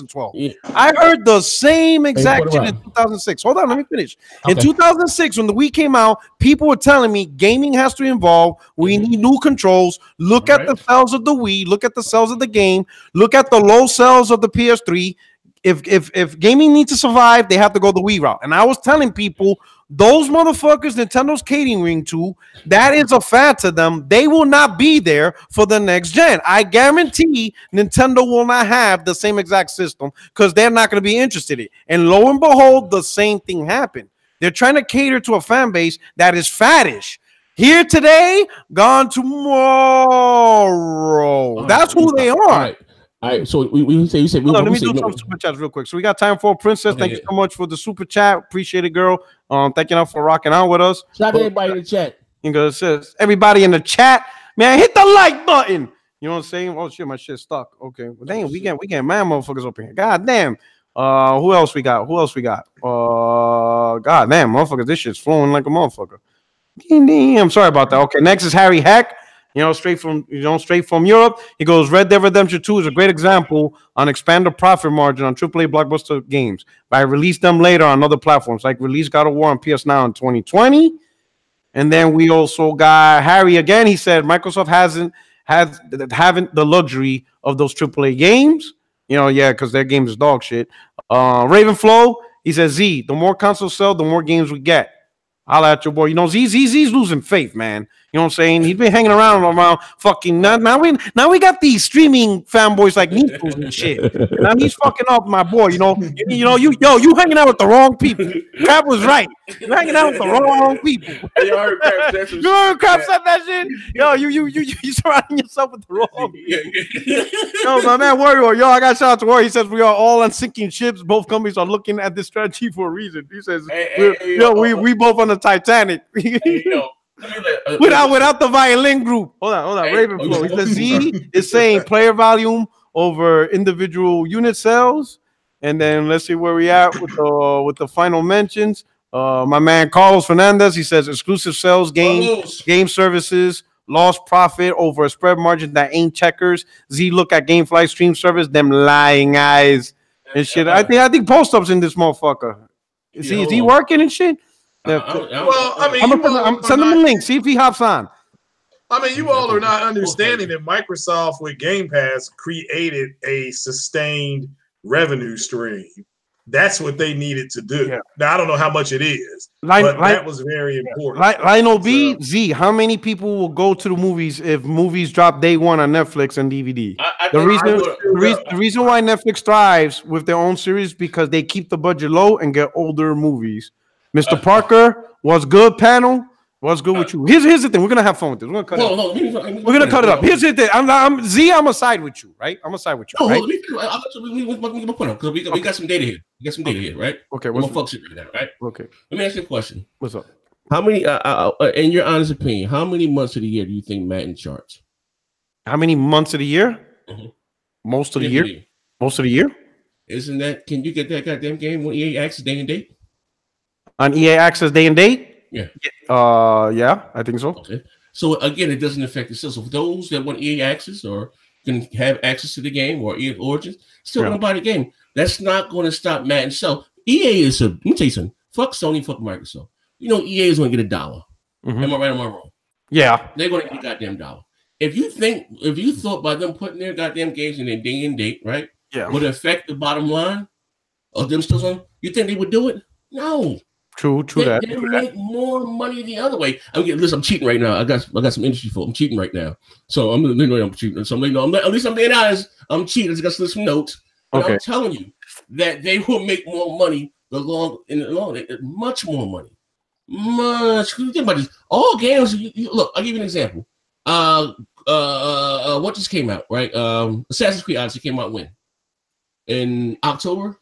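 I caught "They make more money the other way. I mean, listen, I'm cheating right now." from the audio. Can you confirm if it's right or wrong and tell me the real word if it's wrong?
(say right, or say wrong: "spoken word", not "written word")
right.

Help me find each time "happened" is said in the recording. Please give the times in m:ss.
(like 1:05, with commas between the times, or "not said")
0:33.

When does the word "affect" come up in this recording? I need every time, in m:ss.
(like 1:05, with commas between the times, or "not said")
3:39, 3:59.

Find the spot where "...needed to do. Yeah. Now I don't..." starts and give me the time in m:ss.
2:47.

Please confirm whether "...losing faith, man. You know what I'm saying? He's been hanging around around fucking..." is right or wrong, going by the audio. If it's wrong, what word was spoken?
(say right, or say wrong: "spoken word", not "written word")
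right.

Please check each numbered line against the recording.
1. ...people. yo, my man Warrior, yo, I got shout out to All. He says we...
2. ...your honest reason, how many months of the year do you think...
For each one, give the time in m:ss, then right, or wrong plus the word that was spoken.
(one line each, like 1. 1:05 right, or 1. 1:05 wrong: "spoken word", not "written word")
1. 1:56 wrong: "Warrior", not "All"
2. 3:21 wrong: "opinion", not "reason".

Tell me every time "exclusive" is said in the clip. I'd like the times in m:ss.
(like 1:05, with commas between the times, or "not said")
2:21.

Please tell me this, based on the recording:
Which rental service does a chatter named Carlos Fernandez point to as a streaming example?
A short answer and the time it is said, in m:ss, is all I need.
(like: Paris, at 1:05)
GameFly, at 2:27.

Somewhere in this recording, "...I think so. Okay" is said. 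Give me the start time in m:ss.
3:37.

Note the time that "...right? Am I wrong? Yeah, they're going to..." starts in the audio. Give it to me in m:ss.
3:51.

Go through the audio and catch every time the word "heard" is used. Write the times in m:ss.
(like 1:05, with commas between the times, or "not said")
0:00, 1:51.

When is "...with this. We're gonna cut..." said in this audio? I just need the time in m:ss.
3:08.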